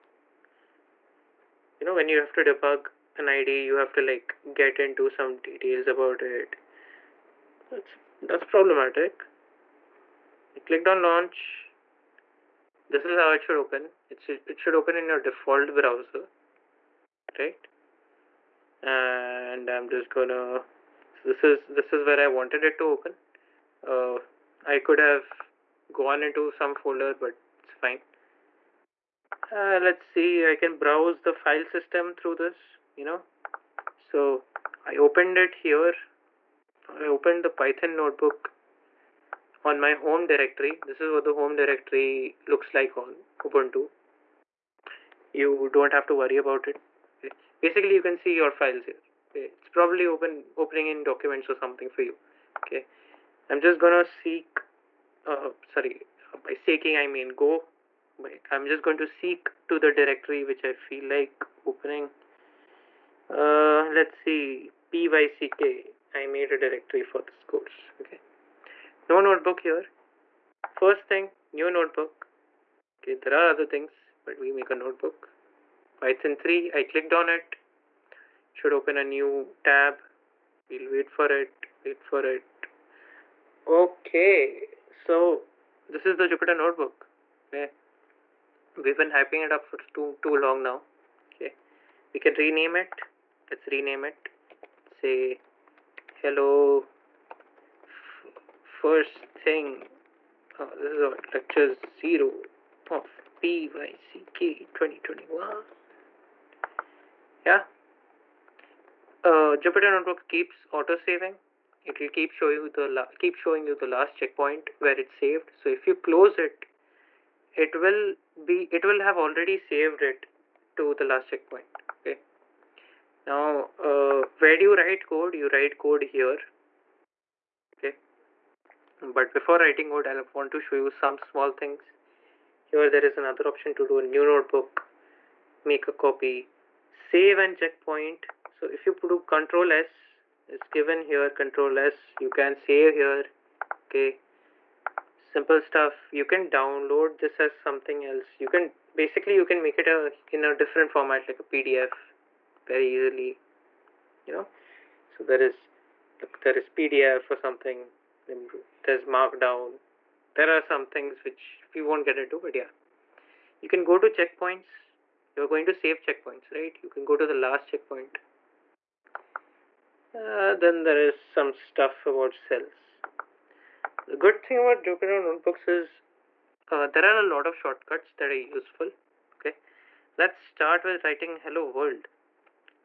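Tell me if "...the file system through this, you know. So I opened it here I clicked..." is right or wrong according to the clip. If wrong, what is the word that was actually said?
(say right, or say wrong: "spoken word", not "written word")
wrong: "opened", not "clicked".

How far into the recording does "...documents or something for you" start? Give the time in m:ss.
0:51.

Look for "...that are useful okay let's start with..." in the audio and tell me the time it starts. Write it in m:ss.
2:58.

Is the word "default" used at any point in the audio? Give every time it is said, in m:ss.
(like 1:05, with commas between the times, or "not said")
0:15.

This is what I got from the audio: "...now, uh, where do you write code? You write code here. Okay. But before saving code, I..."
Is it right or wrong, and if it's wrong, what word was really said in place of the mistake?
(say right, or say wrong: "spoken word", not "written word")
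wrong: "writing", not "saving".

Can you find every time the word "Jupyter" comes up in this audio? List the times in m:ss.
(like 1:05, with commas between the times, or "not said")
1:26, 1:49, 2:54.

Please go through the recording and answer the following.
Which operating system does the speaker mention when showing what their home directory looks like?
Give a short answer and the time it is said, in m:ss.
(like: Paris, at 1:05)
Ubuntu, at 0:43.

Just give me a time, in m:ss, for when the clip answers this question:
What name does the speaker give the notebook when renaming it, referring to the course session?
1:41.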